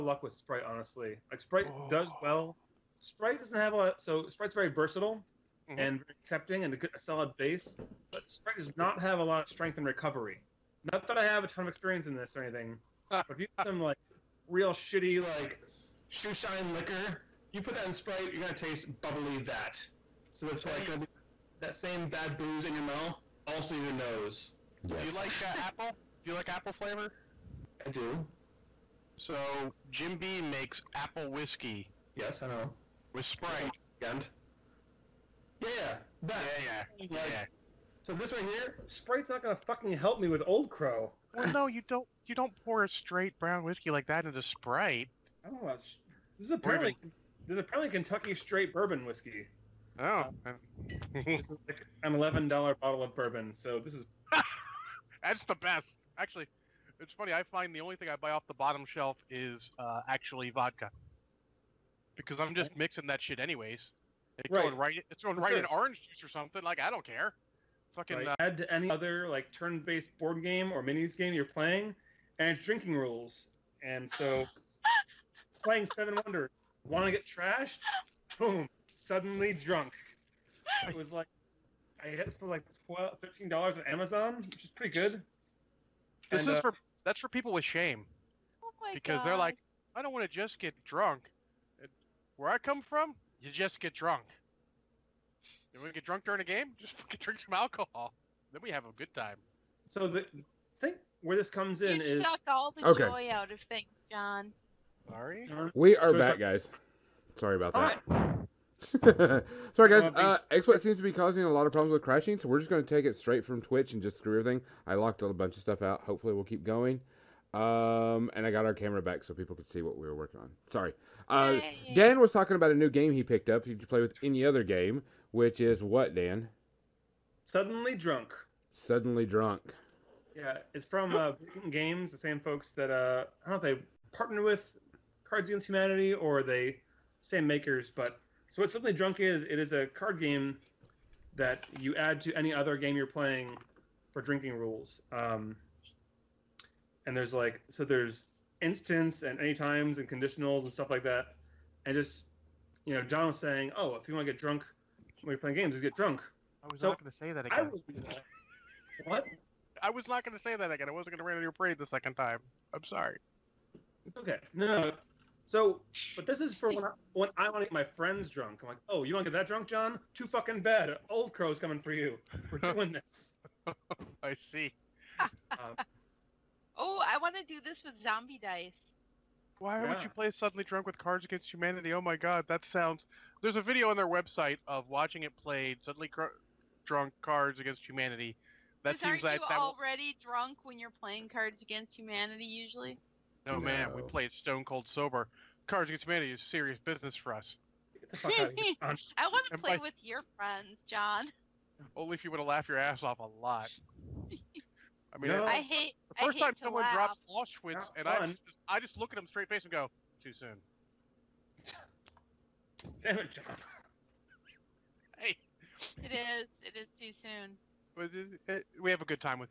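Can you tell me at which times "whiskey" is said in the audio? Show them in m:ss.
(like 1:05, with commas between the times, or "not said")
0:31, 0:43, 0:49.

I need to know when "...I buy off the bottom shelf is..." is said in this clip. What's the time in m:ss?
0:58.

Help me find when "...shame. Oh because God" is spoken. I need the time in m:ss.
1:27.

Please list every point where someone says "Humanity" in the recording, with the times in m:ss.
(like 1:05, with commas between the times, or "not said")
2:15, 3:01, 3:07, 3:11, 3:16.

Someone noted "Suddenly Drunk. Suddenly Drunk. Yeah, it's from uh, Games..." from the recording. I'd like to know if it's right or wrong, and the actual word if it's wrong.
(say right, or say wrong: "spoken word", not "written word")
right.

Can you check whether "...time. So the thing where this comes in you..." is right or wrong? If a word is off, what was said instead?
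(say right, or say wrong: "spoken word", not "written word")
right.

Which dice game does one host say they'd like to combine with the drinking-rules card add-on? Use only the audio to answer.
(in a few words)
Zombie Dice.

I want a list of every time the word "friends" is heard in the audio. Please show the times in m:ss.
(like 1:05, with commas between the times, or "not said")
2:47, 3:20.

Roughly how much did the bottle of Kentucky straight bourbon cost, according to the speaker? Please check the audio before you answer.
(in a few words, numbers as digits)
$11.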